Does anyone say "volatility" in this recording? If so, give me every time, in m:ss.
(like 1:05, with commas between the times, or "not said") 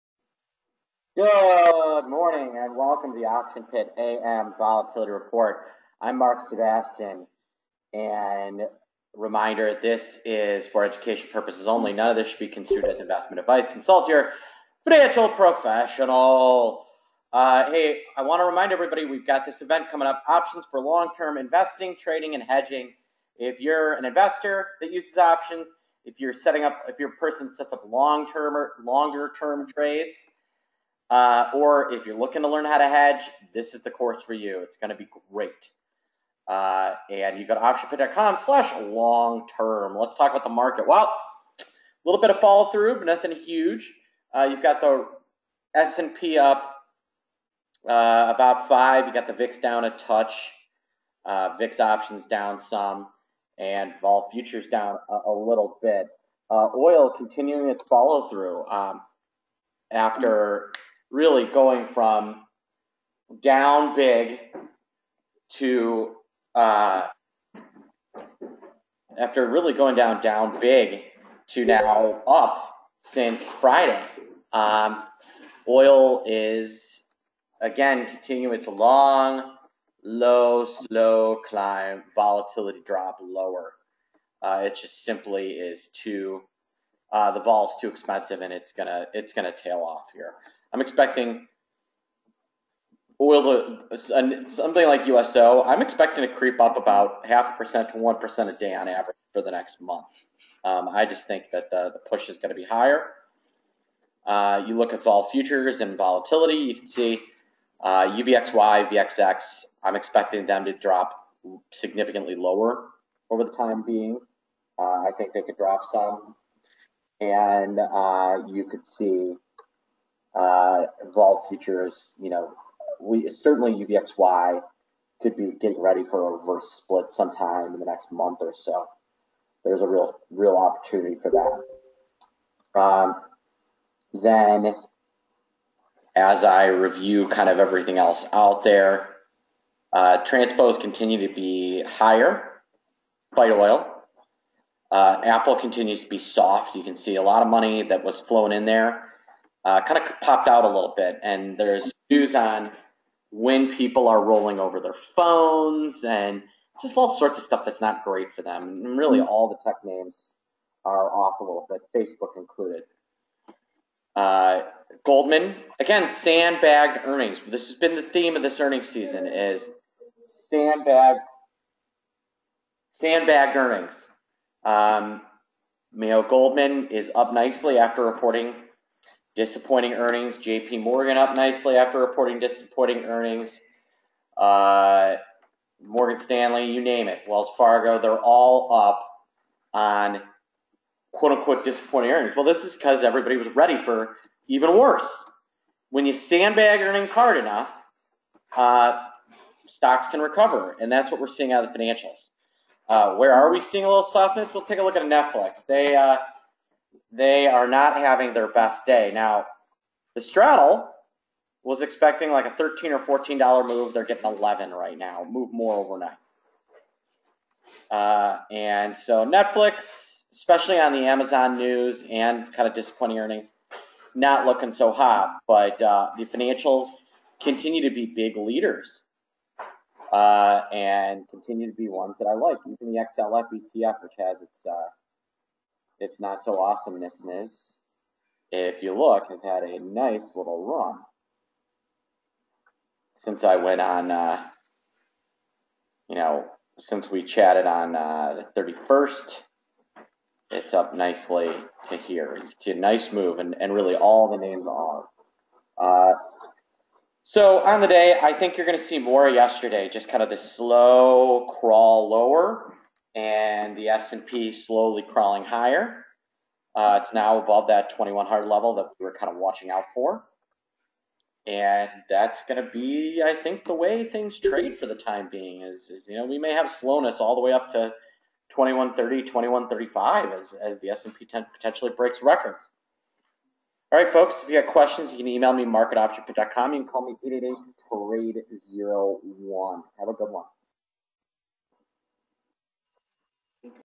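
0:04, 1:22, 1:45.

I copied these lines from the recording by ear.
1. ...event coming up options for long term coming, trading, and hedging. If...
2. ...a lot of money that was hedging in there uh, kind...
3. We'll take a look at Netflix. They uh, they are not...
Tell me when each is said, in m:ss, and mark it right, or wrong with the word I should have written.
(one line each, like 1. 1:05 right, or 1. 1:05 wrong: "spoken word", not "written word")
1. 0:19 wrong: "investing", not "coming"
2. 2:27 wrong: "flowing", not "hedging"
3. 3:24 right.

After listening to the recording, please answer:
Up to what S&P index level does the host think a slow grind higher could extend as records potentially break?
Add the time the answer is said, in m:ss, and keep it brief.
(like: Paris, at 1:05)
2130 to 2135, at 4:38.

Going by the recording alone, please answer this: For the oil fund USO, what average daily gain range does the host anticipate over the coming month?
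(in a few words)
0.5% to 1%.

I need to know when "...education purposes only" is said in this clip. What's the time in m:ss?
0:10.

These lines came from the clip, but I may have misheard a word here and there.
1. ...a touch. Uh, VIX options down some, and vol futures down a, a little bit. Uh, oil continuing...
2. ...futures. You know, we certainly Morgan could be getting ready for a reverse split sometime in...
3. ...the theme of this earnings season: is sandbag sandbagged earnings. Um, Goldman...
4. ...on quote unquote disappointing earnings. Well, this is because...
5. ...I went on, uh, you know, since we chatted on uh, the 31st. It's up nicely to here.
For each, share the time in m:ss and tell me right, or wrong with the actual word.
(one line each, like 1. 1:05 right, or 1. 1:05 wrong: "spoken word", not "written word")
1. 0:49 right
2. 2:01 wrong: "UVXY", not "Morgan"
3. 2:47 right
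4. 3:09 right
5. 4:03 right.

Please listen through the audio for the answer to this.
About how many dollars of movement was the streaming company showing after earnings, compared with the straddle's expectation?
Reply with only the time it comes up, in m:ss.
3:34.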